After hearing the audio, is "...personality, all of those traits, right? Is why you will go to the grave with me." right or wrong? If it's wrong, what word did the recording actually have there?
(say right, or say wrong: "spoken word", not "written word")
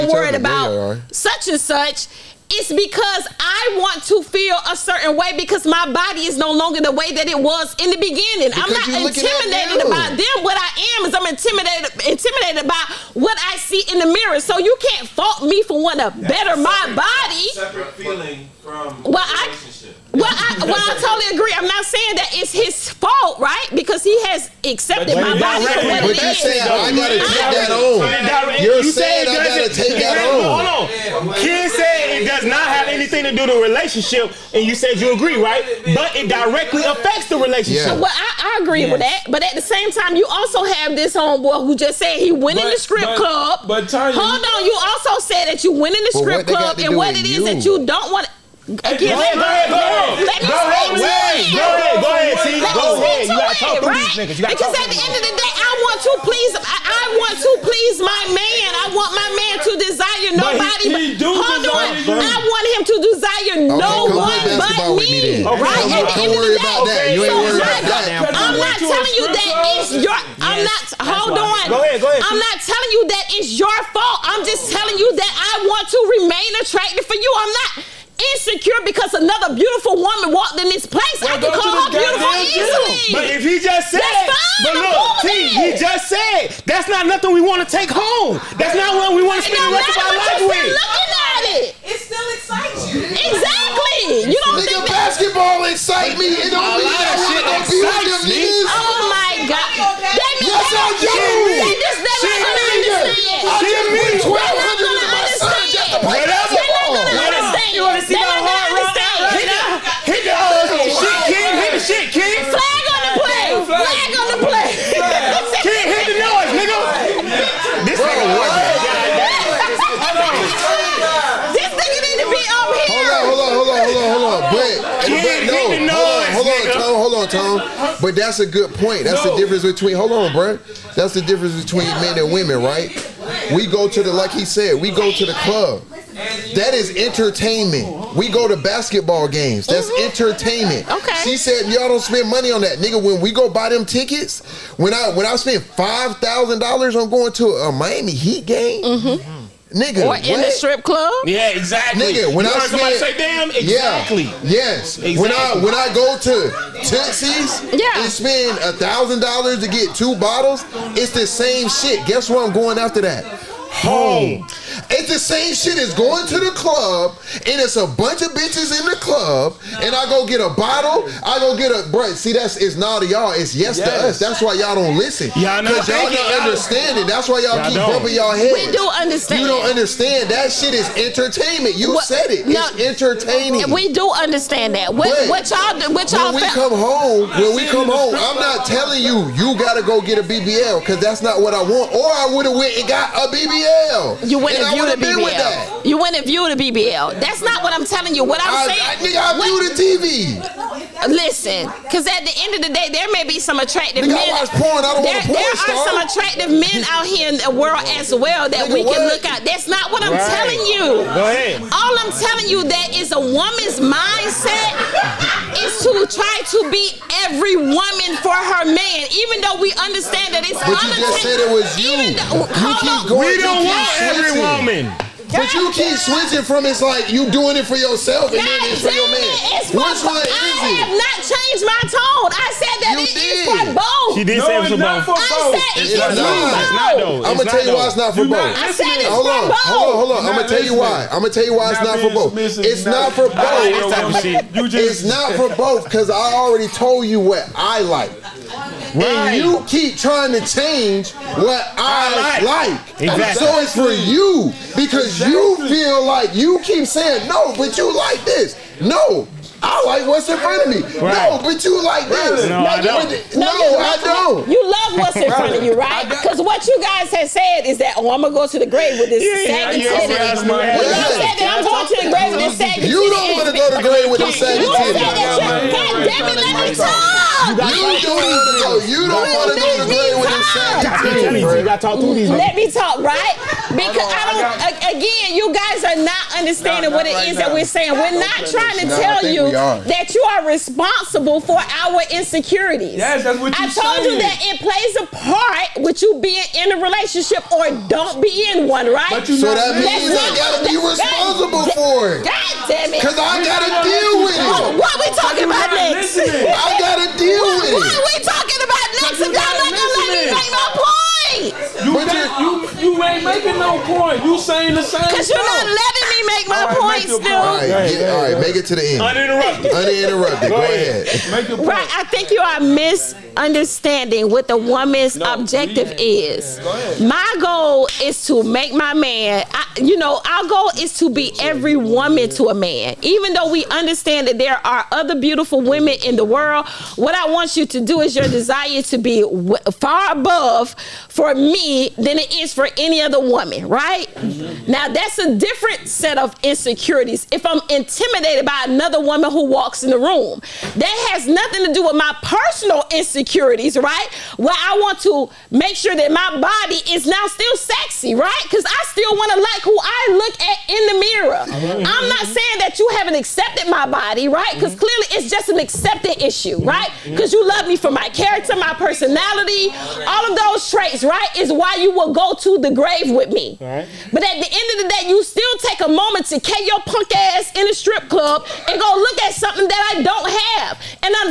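right.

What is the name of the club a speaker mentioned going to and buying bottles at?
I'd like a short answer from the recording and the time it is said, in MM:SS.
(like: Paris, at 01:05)
Tootsie's, at 02:36.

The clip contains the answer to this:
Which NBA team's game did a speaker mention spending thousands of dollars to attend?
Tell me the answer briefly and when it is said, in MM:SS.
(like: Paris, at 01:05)
Miami Heat, at 02:27.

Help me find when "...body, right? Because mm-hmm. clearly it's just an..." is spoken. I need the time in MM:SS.
06:03.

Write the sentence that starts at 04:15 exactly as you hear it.
You feel like you keep saying no, but you like this.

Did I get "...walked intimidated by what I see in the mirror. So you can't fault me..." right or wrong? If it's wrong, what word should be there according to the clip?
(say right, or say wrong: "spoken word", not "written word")
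wrong: "intimidated", not "walked".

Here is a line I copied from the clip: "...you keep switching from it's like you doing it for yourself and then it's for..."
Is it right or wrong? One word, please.
right.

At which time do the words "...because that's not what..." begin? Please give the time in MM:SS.
03:10.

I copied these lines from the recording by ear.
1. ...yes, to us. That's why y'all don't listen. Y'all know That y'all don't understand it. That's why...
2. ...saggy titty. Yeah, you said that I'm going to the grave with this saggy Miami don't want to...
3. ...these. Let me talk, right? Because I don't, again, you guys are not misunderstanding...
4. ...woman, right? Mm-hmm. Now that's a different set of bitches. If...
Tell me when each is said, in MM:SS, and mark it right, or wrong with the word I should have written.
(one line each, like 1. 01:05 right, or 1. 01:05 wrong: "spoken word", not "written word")
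1. 02:53 wrong: "Cause", not "That"
2. 04:29 wrong: "You", not "Miami"
3. 04:42 wrong: "understanding", not "misunderstanding"
4. 05:43 wrong: "insecurities", not "bitches".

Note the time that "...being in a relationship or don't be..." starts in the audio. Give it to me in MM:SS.
04:56.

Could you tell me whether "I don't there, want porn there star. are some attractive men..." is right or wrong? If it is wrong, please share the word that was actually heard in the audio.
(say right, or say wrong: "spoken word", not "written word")
right.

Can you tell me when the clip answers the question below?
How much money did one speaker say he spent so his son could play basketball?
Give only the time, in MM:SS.
01:44.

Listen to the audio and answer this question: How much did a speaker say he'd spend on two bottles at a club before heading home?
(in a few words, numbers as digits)
1000 dollars.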